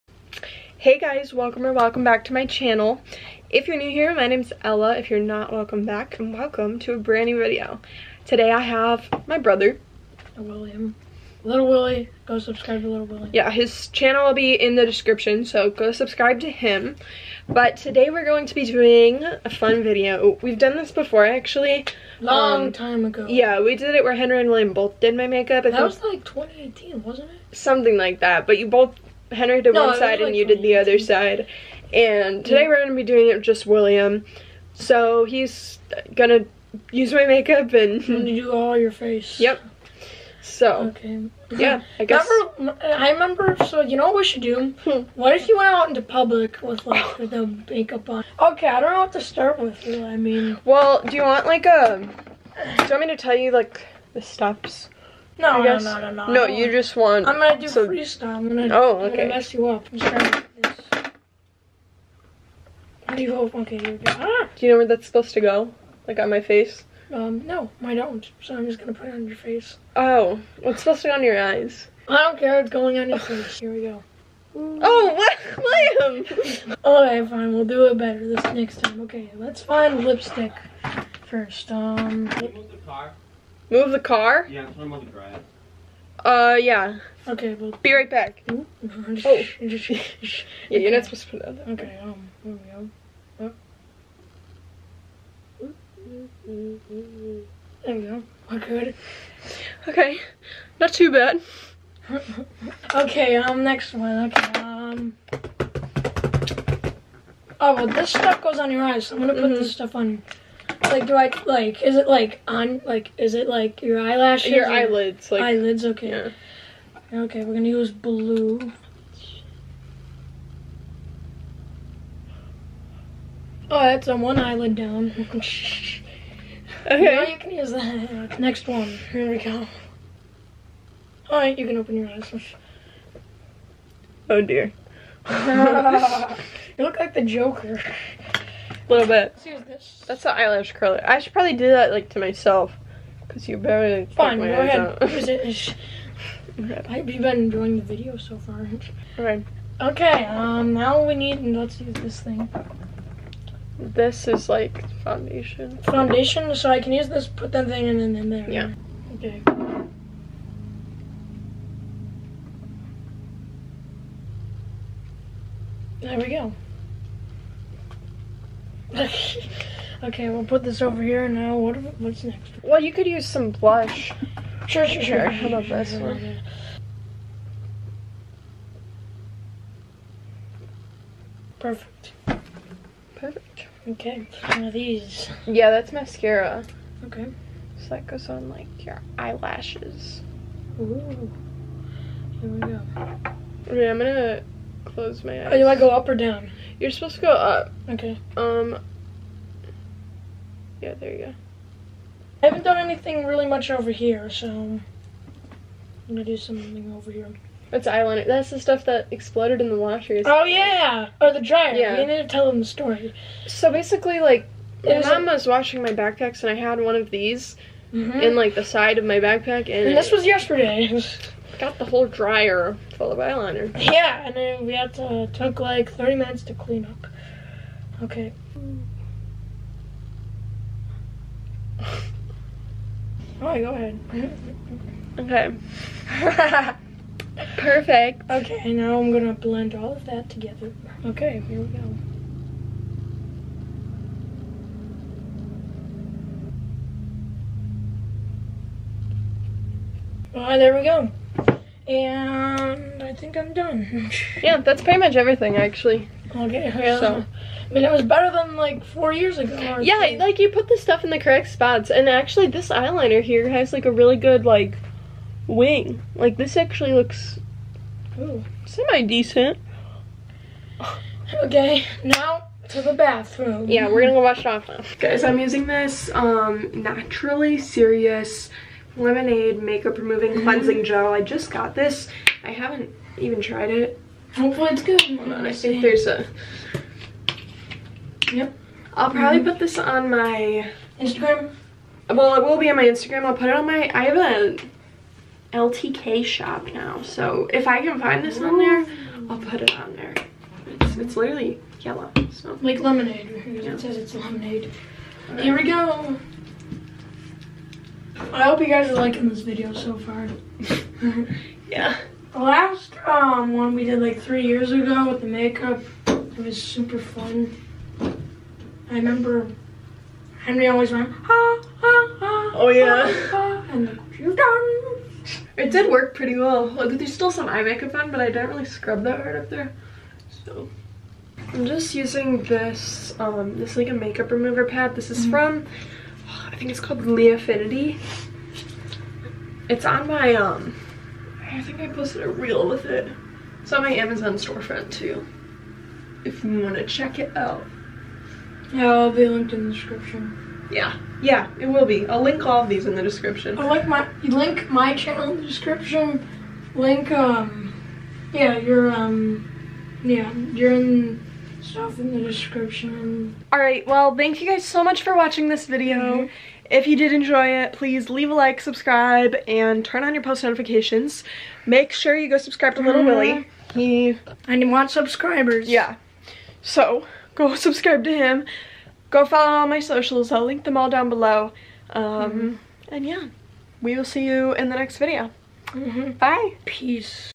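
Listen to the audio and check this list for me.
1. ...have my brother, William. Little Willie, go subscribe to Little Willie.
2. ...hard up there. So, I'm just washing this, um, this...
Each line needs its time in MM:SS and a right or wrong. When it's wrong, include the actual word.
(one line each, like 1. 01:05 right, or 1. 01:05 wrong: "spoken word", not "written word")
1. 00:08 right
2. 05:29 wrong: "using", not "washing".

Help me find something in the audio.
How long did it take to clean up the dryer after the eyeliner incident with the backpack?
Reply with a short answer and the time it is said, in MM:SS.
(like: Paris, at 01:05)
30 minutes, at 03:45.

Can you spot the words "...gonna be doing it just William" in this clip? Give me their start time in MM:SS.
00:32.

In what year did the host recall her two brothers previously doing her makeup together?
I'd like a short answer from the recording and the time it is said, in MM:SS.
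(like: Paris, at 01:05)
2018, at 00:26.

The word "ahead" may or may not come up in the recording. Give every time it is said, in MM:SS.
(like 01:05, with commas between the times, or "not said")
02:24, 03:53.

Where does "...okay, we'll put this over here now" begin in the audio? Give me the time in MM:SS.
02:50.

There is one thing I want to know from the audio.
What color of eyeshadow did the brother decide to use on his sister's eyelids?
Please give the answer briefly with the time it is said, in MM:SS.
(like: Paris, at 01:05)
Blue, at 01:57.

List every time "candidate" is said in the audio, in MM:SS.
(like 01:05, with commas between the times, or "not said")
not said.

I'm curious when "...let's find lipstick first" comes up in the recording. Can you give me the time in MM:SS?
01:19.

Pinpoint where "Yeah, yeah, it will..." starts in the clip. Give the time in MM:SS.
05:50.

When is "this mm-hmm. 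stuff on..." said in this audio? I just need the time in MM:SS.
01:49.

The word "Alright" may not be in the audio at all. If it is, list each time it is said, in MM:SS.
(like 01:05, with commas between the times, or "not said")
04:10, 06:03.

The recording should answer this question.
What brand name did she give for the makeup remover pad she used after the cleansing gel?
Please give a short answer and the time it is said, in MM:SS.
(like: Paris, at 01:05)
Leafinity, at 05:37.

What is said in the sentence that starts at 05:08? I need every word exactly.
I hope you guys are liking this video so far.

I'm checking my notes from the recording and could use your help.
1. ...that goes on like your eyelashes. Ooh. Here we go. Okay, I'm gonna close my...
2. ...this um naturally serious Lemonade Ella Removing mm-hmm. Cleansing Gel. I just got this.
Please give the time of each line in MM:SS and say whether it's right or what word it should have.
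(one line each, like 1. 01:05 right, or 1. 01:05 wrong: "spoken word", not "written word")
1. 03:07 right
2. 04:35 wrong: "Makeup", not "Ella".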